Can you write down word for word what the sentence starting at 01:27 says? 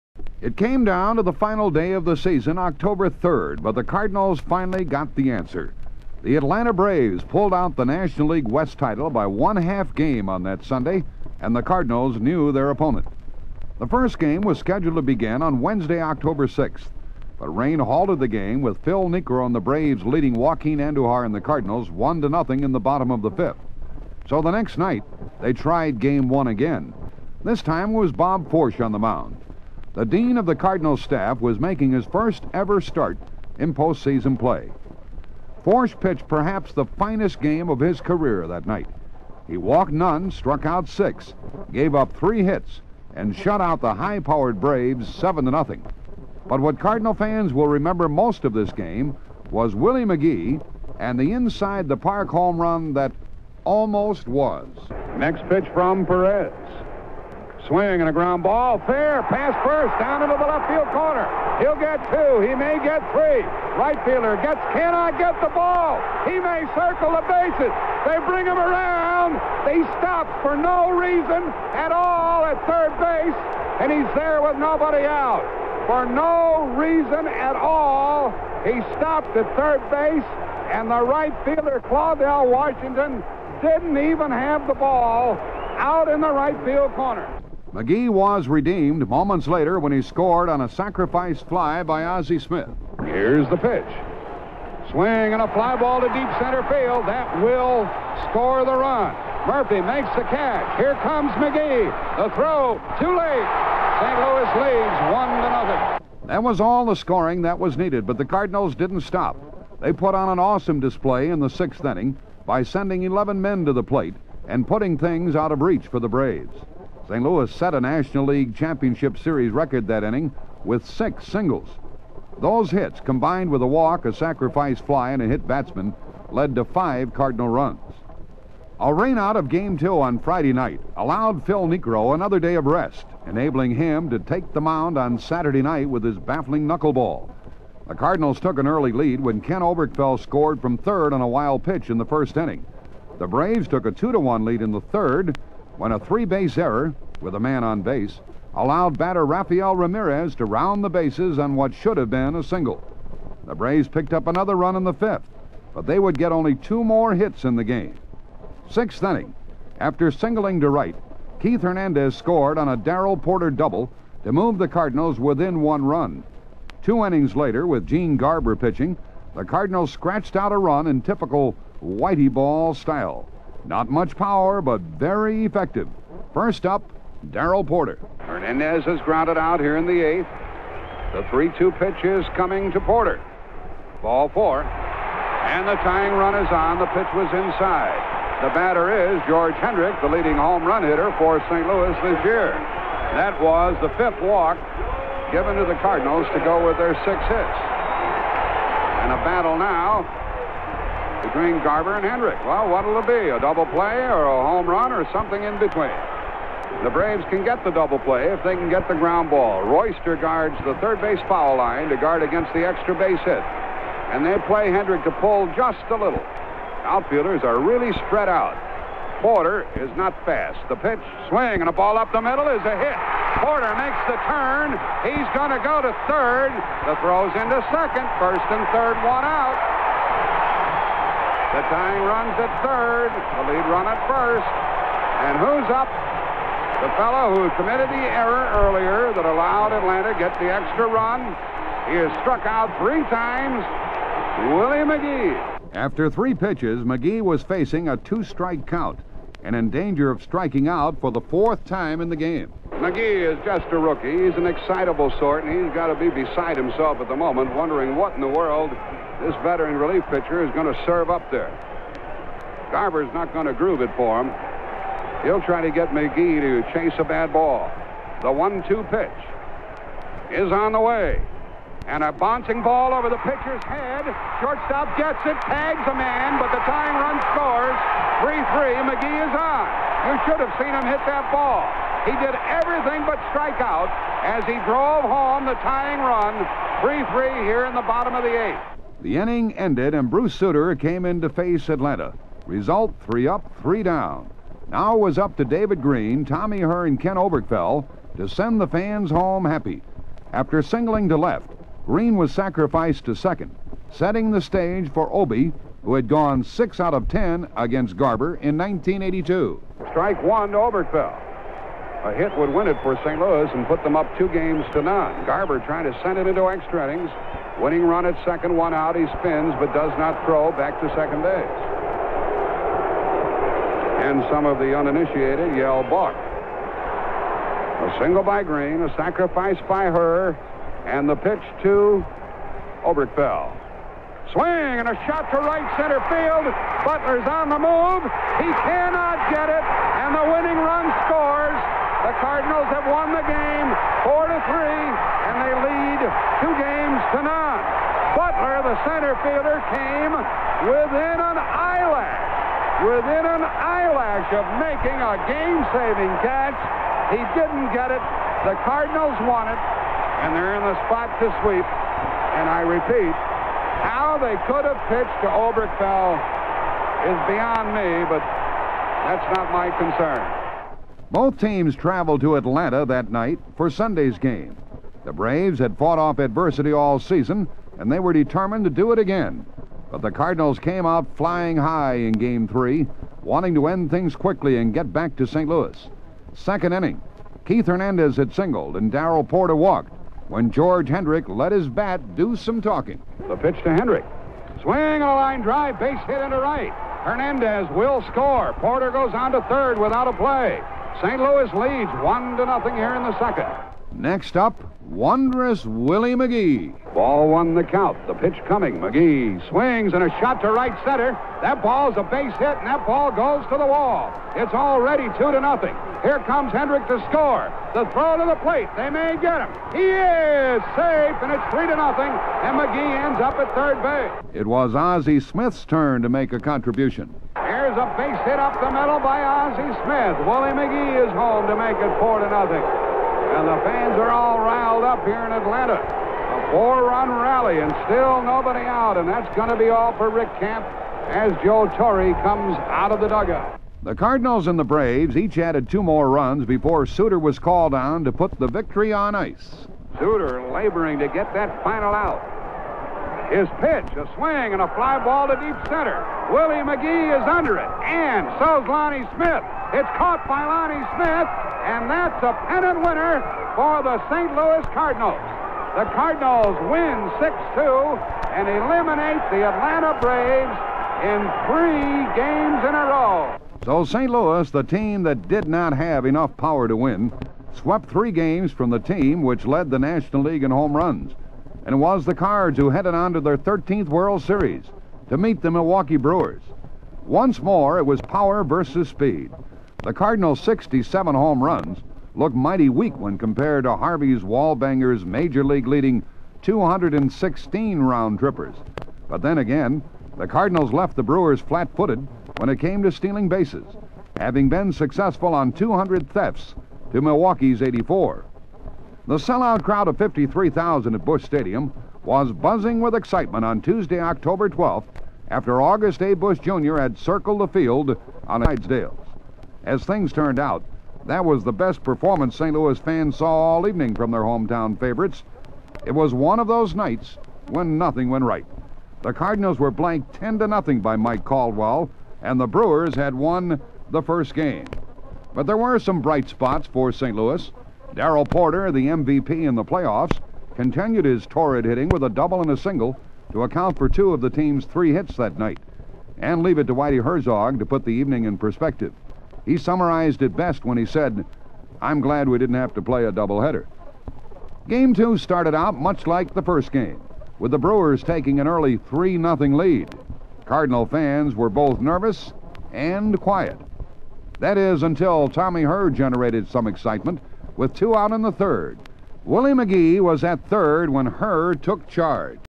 McGee was redeemed moments later when he scored on a sacrifice fly by Ozzie Smith.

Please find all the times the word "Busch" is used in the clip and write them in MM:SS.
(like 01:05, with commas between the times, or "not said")
08:31, 08:36.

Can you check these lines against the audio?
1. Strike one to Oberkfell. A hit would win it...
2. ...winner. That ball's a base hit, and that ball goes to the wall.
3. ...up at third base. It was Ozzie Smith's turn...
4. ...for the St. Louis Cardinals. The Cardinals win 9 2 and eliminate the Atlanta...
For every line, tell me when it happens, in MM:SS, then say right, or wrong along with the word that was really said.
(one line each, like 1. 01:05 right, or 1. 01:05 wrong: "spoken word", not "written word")
1. 05:09 right
2. 06:50 wrong: "center", not "winner"
3. 07:03 right
4. 07:43 wrong: "6", not "9".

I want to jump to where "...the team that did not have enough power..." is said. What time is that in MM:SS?
07:54.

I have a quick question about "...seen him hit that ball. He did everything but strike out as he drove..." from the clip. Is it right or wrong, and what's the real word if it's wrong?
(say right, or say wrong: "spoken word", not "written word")
right.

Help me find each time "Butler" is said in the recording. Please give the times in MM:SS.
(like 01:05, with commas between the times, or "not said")
05:36, 05:47.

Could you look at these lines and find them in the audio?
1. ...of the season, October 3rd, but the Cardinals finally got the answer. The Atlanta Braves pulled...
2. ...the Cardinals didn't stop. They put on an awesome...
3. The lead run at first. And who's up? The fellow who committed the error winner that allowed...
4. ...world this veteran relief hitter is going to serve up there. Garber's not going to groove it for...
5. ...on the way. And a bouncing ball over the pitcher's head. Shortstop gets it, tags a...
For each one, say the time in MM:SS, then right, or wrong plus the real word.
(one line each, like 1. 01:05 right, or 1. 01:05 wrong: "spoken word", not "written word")
1. 00:01 right
2. 01:48 right
3. 03:53 wrong: "earlier", not "winner"
4. 04:18 wrong: "pitcher", not "hitter"
5. 04:30 right.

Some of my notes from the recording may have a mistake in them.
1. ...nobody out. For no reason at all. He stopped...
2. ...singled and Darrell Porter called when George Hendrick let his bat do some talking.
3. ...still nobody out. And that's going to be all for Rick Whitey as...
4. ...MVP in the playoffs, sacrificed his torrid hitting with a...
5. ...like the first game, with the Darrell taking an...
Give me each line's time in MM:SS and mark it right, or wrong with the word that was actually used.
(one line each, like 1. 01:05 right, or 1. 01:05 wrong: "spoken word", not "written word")
1. 01:14 right
2. 06:28 wrong: "walked", not "called"
3. 07:17 wrong: "Camp", not "Whitey"
4. 08:58 wrong: "continued", not "sacrificed"
5. 09:16 wrong: "Brewers", not "Darrell".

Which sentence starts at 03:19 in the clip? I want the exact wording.
And a battle now between Garber and Hendrick.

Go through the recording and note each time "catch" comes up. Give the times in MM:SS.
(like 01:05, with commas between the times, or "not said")
01:40, 05:56.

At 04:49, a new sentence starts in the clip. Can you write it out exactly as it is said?
The inning ended, and Bruce Sutter came in to face Atlanta.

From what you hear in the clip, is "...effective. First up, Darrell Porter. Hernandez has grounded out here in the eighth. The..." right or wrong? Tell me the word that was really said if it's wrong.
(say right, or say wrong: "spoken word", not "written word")
right.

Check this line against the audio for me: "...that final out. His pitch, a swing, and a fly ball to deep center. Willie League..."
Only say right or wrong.
wrong.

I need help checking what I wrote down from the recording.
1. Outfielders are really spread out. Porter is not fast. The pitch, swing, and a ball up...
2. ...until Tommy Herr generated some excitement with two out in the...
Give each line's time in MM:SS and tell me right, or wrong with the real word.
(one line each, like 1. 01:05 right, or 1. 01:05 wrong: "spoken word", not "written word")
1. 03:36 right
2. 09:24 right.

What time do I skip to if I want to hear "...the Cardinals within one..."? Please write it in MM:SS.
02:44.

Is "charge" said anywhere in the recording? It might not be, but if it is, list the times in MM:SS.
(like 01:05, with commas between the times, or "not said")
09:31.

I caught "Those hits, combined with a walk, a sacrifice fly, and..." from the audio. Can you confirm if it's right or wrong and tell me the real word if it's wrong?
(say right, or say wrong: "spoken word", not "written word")
right.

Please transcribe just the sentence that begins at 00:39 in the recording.
He walked none, struck out six, gave up three hits, and shut out the high powered Braves 7 to nothing.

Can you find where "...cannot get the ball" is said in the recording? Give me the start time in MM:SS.
01:04.